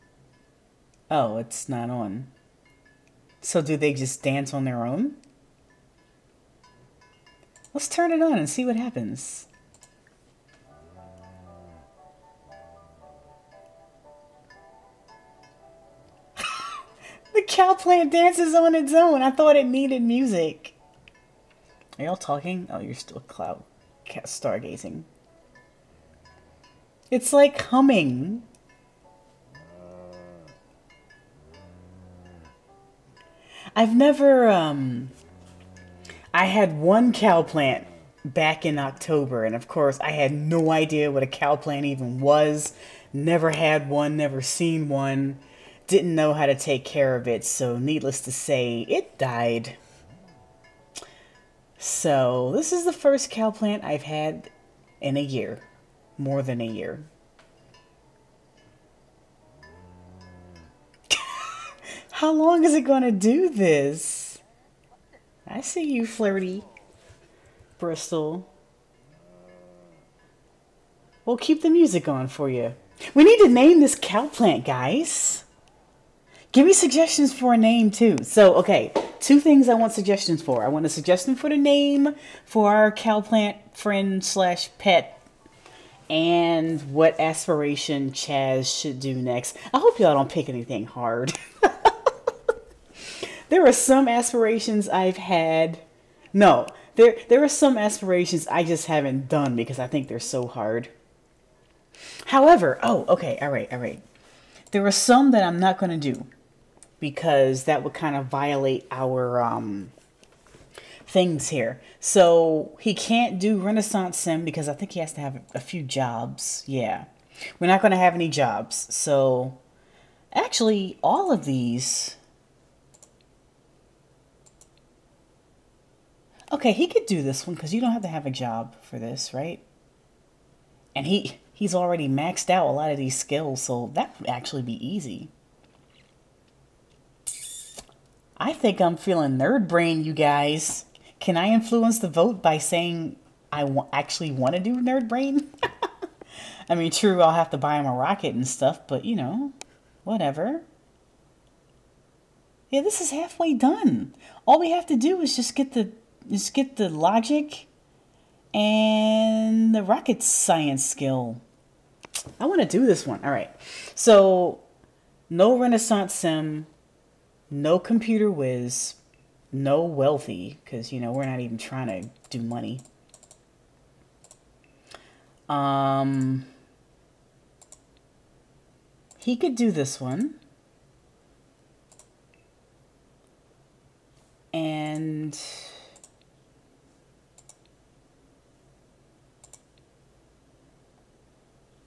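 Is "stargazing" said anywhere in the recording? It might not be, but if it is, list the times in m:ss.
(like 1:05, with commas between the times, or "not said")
0:24.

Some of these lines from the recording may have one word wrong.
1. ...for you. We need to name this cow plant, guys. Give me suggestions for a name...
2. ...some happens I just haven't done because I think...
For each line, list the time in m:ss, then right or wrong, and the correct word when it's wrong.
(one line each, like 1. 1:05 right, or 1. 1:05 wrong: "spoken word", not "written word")
1. 1:12 right
2. 1:37 wrong: "aspirations", not "happens".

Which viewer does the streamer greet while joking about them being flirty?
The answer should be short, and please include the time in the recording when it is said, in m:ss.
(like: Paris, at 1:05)
Bristol, at 1:07.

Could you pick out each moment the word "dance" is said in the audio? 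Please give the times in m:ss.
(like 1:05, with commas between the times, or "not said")
0:04, 0:18.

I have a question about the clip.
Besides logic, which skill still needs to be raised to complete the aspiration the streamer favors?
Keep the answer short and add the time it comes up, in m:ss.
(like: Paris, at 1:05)
rocket science, at 2:39.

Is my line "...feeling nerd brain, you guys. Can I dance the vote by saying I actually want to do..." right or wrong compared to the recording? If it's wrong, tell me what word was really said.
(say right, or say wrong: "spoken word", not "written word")
wrong: "influence", not "dance".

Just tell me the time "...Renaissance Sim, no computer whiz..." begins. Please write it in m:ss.
2:45.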